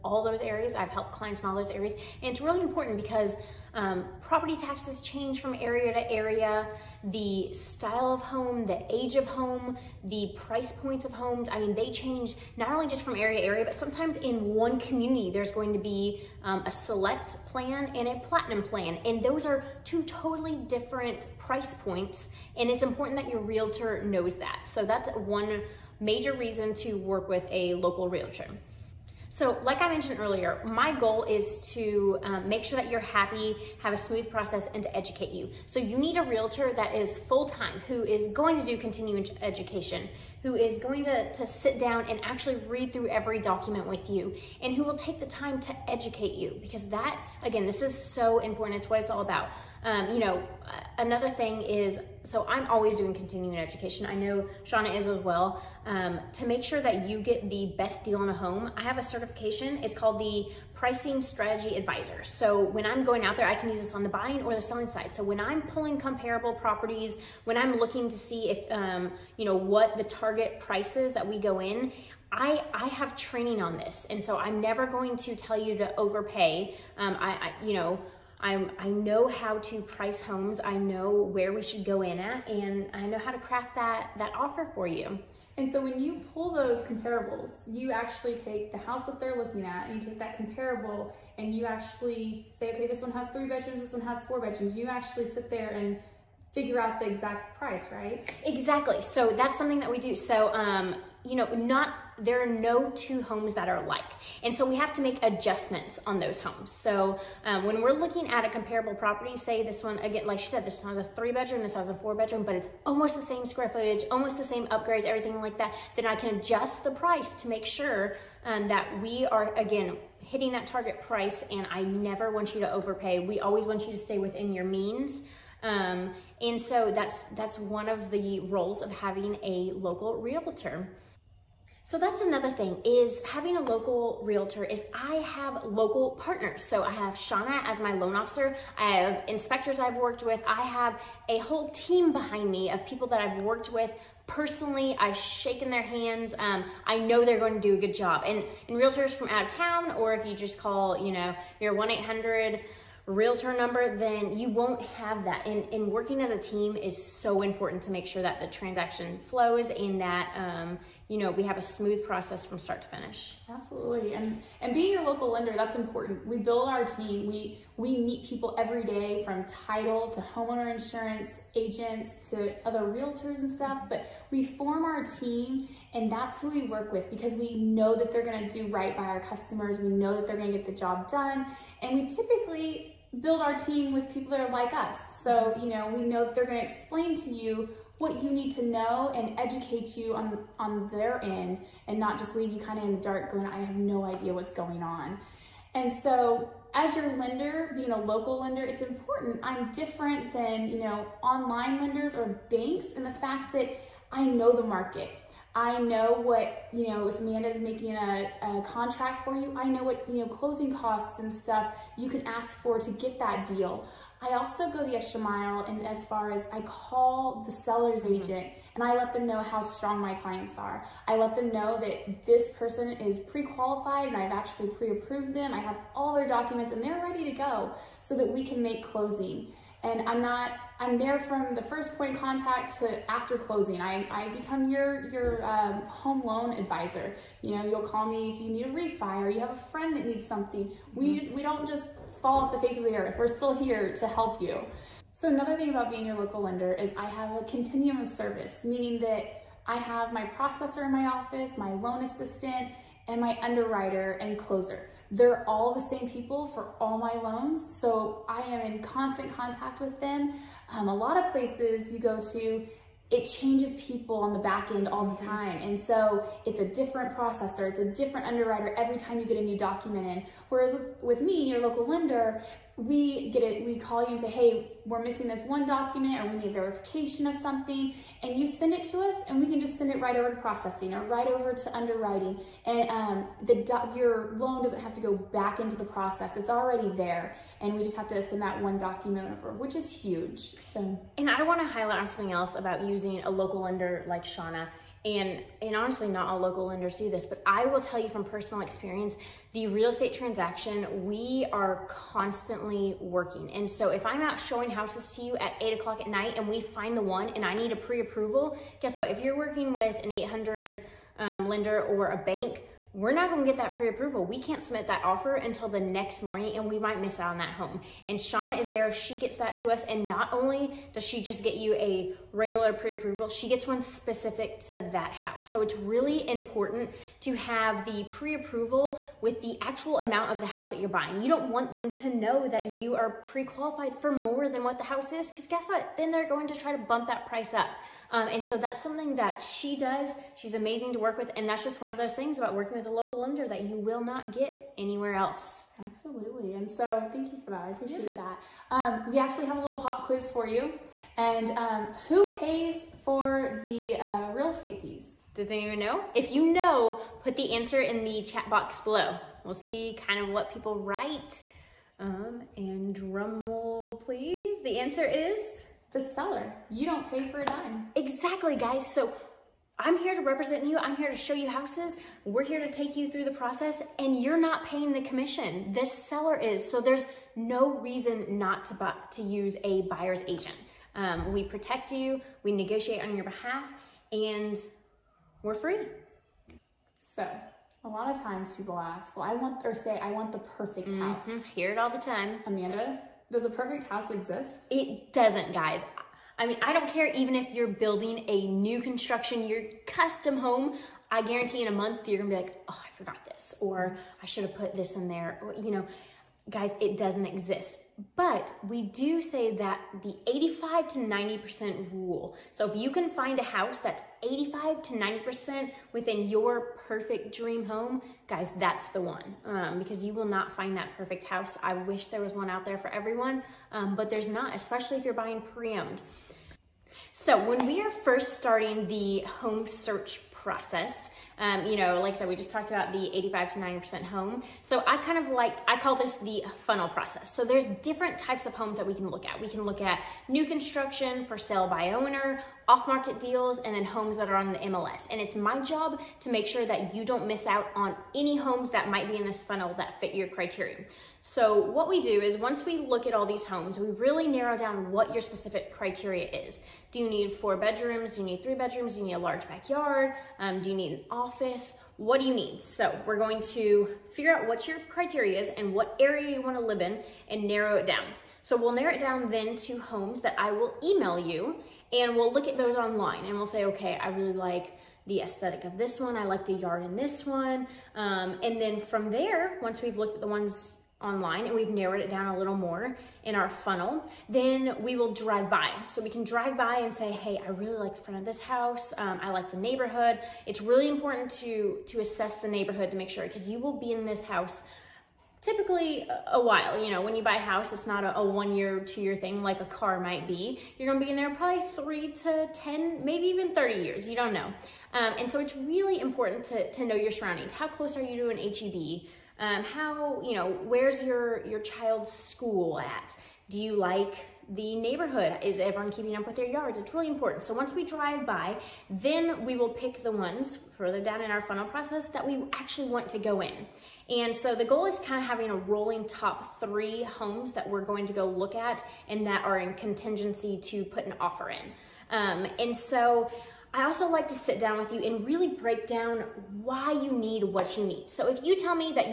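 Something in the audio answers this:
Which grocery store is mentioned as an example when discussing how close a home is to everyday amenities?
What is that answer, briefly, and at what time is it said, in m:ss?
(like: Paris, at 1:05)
HEB, at 8:28.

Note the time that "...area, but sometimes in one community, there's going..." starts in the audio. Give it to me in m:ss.
0:13.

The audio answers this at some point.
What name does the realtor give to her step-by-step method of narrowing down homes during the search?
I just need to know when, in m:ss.
7:16.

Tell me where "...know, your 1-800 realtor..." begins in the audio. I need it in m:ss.
2:31.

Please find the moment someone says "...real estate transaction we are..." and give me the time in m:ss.
4:59.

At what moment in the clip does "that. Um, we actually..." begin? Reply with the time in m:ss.
5:48.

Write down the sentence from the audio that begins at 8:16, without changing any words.
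You know, when you buy a house, it's not a, a, one year, two year thing like a car might be.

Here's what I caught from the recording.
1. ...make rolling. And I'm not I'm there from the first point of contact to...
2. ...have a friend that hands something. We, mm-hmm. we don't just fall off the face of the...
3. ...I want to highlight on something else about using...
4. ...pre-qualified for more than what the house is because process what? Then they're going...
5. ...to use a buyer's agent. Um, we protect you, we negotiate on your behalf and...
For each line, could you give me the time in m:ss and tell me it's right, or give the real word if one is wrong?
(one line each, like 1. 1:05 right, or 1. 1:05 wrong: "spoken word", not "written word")
1. 3:48 wrong: "closing", not "rolling"
2. 3:59 wrong: "needs", not "hands"
3. 4:51 right
4. 5:33 wrong: "guess", not "process"
5. 6:19 right.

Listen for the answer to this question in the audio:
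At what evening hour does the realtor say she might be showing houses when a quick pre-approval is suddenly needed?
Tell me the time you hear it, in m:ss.
5:05.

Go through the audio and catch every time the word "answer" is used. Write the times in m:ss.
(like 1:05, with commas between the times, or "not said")
5:57, 6:04.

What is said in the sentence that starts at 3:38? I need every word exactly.
agent and I let them know how strong my clients are.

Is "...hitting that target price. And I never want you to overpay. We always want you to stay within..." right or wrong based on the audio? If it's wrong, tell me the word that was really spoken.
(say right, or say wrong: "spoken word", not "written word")
right.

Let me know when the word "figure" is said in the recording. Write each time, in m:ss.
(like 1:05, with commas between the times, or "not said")
1:36, 7:44.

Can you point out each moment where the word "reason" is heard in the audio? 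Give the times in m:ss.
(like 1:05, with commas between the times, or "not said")
0:26, 6:17.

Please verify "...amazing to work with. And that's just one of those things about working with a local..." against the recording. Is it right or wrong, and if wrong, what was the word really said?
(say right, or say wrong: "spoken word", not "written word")
right.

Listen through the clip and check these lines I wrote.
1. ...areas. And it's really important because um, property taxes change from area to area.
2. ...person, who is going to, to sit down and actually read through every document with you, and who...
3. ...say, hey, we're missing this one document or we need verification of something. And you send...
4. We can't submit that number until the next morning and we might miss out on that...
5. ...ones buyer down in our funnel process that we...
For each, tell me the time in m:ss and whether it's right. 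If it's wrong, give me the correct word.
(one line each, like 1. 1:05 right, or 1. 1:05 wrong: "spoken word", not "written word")
1. 0:01 right
2. 0:39 wrong: "education", not "person"
3. 4:34 right
4. 5:14 wrong: "offer", not "number"
5. 8:40 wrong: "further", not "buyer".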